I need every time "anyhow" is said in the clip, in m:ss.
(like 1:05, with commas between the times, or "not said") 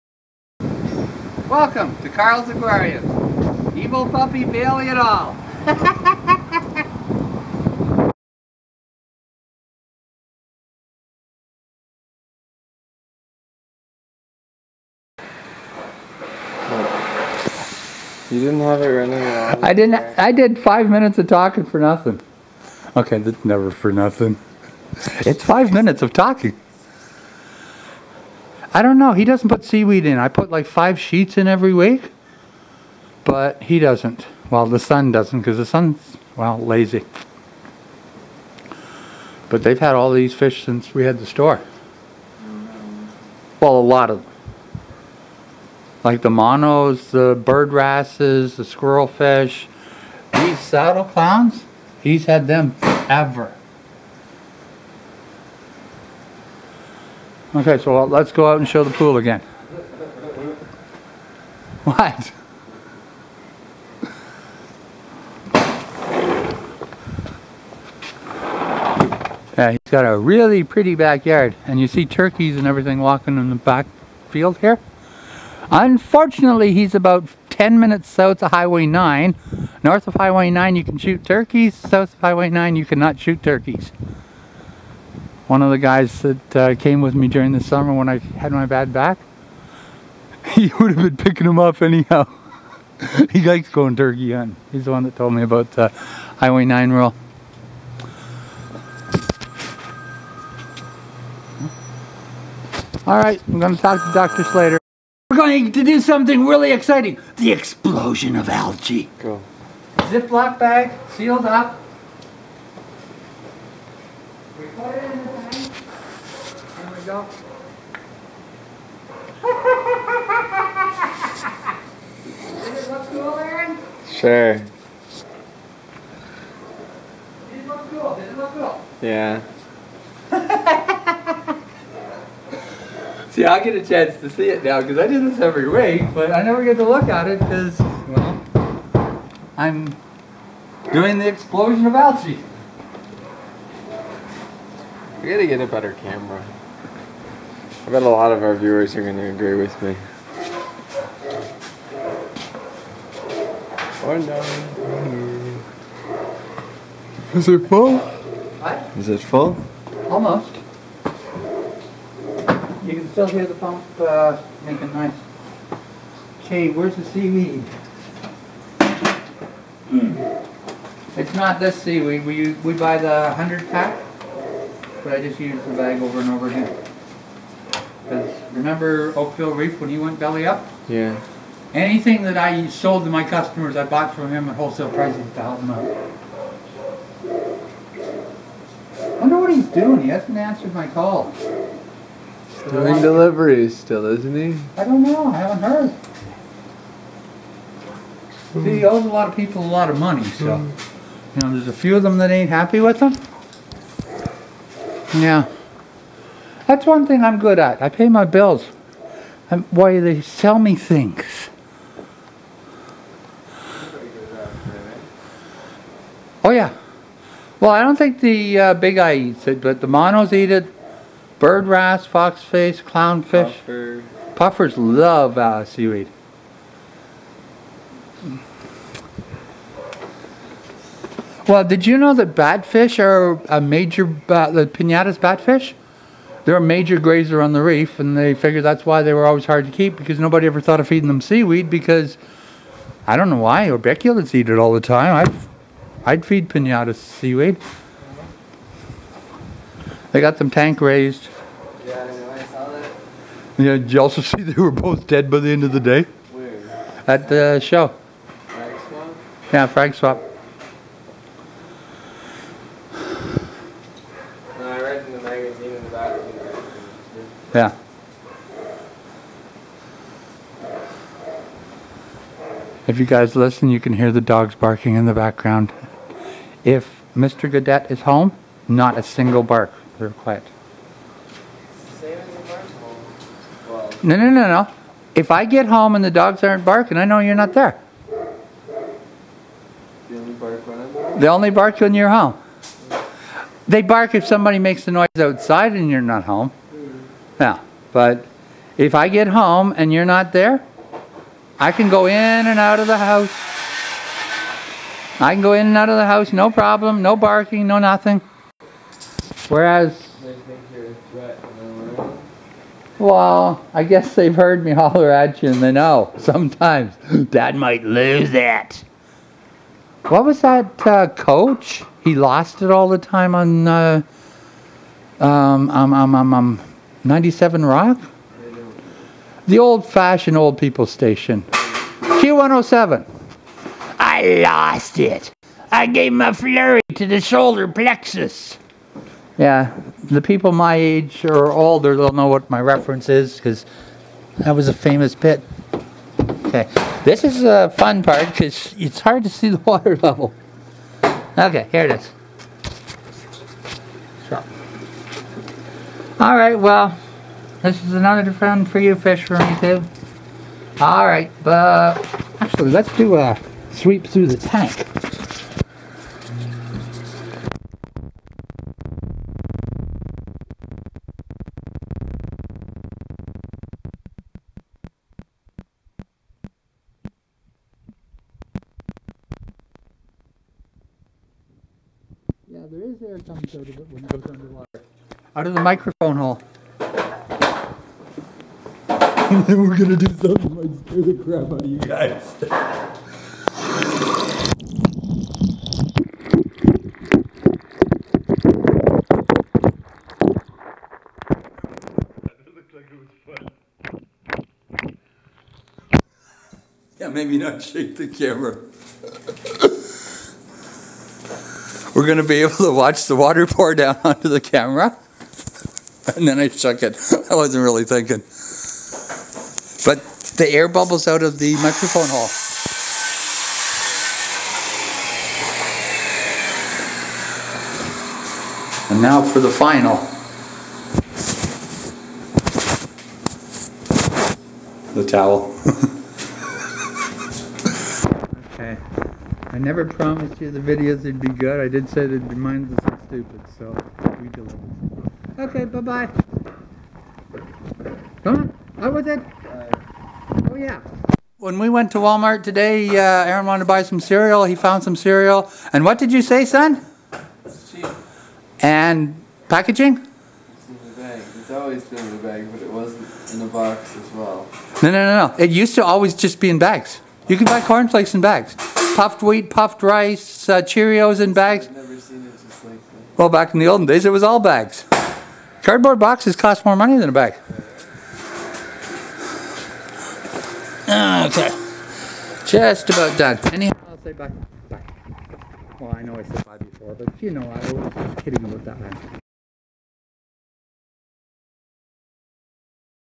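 1:31, 8:03.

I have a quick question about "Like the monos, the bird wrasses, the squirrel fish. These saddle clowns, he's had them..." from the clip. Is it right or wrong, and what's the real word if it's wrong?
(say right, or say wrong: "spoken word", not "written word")
right.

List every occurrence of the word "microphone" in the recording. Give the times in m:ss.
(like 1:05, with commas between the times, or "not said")
6:25, 7:01.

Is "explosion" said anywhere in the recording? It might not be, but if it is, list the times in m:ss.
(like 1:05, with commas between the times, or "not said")
1:47, 2:21.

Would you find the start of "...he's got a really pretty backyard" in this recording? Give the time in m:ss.
1:09.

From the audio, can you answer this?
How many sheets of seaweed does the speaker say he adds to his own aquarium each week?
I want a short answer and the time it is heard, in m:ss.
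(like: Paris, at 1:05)
5, at 0:30.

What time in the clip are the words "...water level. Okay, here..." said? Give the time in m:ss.
5:49.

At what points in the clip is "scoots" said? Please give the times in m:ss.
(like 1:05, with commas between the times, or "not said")
not said.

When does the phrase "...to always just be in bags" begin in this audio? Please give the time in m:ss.
7:45.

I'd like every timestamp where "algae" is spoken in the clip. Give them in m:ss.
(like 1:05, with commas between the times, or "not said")
1:48, 2:21.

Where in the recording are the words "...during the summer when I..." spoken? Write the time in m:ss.
1:27.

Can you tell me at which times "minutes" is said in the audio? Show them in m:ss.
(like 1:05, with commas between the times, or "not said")
0:20, 0:25, 1:17.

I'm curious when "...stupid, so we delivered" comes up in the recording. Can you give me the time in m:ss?
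7:23.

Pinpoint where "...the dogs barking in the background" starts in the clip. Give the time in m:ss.
4:34.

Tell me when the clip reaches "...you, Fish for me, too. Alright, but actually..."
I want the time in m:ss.
5:58.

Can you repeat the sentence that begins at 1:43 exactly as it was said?
All right, I'm going to talk to Dr.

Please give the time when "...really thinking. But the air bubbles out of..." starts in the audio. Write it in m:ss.
6:57.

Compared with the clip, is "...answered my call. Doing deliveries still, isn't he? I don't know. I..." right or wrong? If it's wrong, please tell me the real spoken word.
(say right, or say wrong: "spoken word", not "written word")
right.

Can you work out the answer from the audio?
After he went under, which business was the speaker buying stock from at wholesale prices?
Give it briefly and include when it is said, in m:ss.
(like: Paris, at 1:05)
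Oakville Reef, at 2:59.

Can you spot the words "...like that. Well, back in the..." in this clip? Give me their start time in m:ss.
7:52.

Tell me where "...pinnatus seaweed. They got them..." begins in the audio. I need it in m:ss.
4:06.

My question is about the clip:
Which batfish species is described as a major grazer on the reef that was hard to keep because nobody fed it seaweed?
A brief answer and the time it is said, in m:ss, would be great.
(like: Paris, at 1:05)
Pinnatus batfish, at 3:54.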